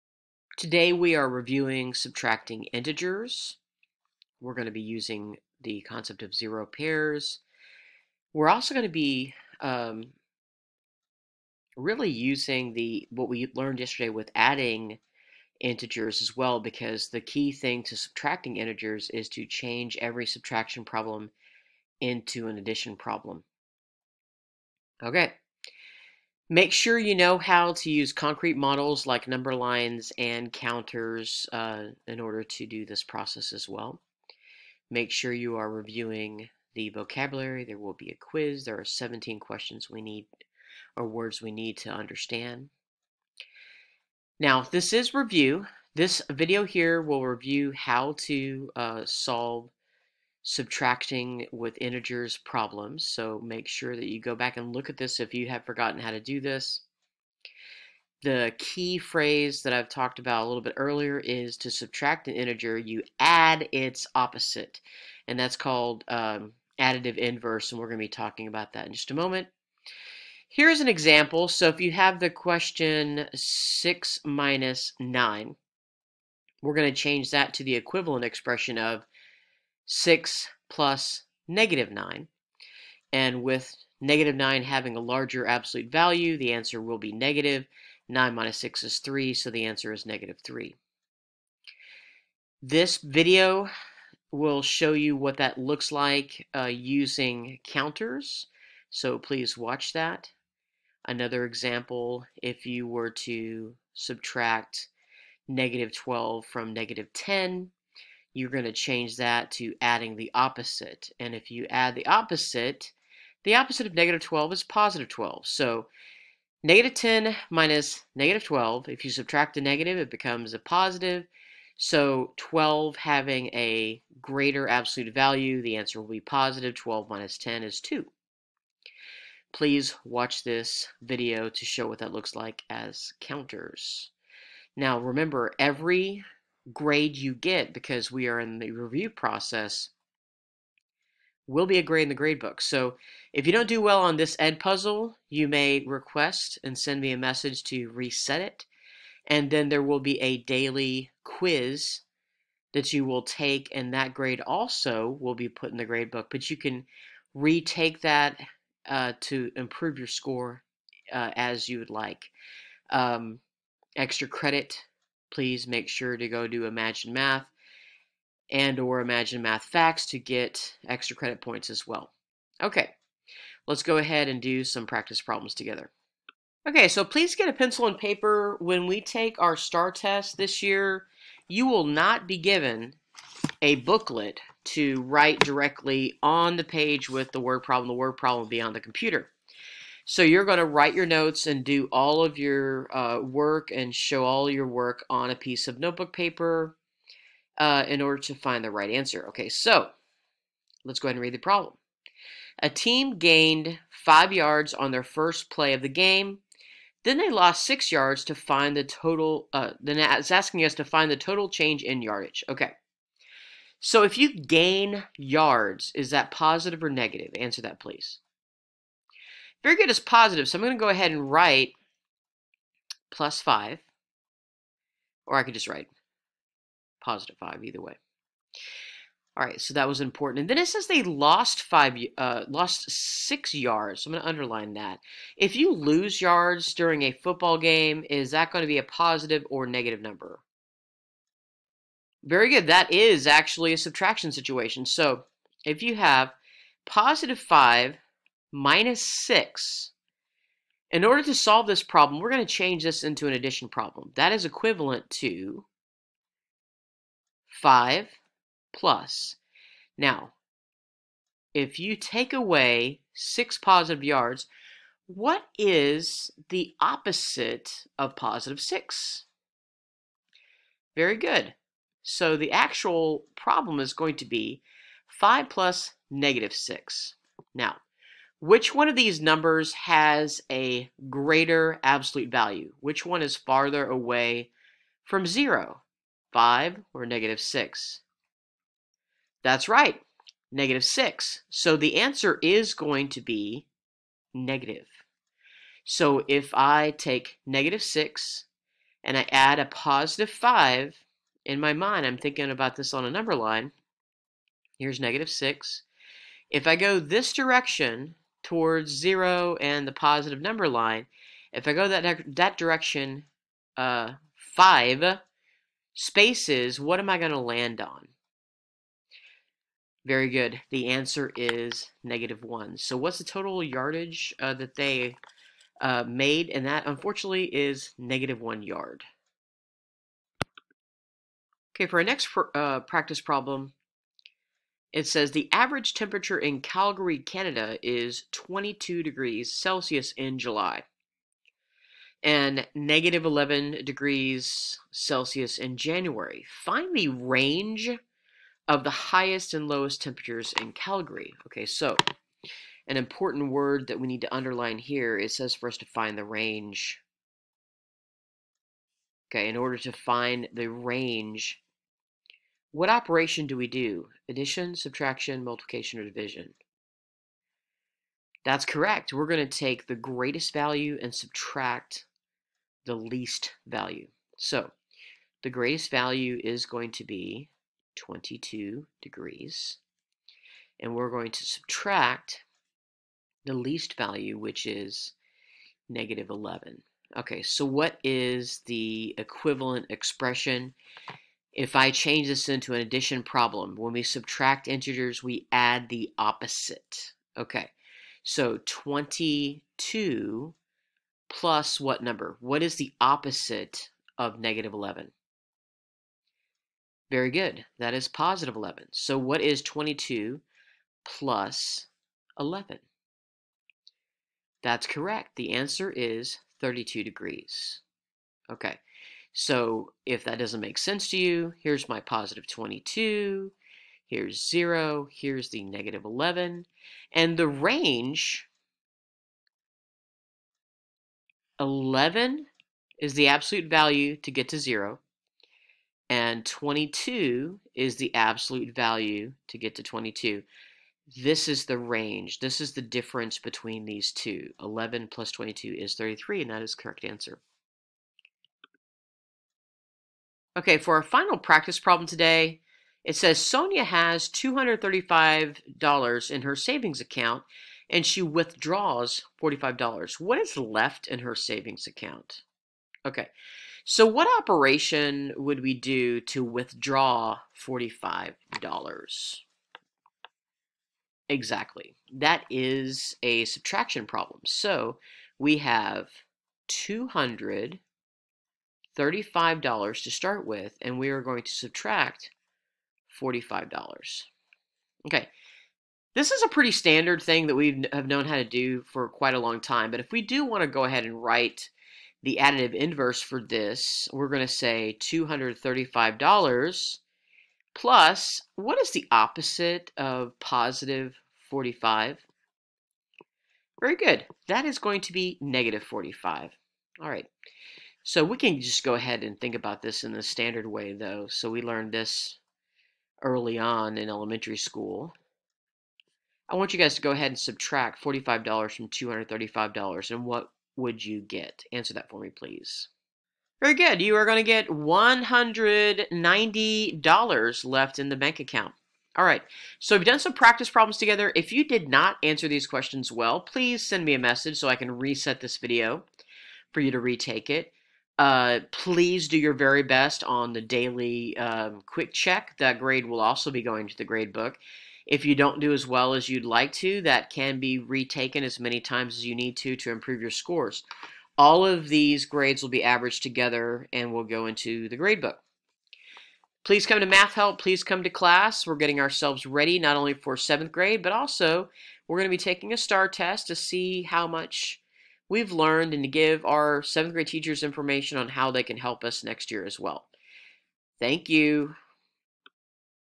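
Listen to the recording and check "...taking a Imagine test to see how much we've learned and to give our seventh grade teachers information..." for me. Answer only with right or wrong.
wrong.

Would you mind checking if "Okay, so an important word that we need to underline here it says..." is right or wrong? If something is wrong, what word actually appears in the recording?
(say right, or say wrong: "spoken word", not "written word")
right.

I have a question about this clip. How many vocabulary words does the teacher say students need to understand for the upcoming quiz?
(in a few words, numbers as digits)
17.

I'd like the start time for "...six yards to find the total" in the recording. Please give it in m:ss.
3:27.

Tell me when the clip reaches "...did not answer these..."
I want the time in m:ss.
8:51.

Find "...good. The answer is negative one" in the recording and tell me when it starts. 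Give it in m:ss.
5:20.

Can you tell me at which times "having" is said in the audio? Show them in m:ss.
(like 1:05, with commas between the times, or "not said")
1:24, 2:02.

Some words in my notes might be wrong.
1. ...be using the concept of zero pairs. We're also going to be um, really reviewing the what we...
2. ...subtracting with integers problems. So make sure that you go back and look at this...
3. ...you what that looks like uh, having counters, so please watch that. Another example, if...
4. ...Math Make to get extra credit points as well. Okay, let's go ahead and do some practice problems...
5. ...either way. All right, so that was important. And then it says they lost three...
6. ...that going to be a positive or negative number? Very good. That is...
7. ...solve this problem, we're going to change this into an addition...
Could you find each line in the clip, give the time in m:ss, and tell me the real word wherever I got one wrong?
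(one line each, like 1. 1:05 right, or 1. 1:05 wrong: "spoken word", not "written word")
1. 0:04 wrong: "using", not "reviewing"
2. 0:50 right
3. 1:34 wrong: "using", not "having"
4. 2:49 wrong: "Facts", not "Make"
5. 3:47 wrong: "five", not "three"
6. 3:58 right
7. 4:11 right.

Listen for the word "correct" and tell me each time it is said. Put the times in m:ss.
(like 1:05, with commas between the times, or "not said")
6:08, 6:54, 7:26.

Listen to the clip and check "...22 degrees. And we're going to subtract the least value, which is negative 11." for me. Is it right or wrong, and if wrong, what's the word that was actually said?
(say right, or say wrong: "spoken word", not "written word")
right.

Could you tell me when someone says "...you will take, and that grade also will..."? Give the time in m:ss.
2:32.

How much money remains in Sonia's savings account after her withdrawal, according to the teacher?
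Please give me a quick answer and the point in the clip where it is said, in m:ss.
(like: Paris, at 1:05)
$190, at 8:44.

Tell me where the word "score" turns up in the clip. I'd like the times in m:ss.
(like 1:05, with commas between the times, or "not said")
2:40, 9:10.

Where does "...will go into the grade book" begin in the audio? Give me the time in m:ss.
9:14.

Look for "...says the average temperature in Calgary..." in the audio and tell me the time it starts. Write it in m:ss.
5:35.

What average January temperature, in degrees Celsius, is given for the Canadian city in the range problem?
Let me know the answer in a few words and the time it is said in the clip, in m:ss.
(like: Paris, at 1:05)
-11 degrees Celsius, at 5:42.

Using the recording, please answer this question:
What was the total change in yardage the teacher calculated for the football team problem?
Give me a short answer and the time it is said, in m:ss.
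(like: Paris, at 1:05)
-1 yard, at 5:27.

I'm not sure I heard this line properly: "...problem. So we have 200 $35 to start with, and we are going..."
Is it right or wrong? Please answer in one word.
right.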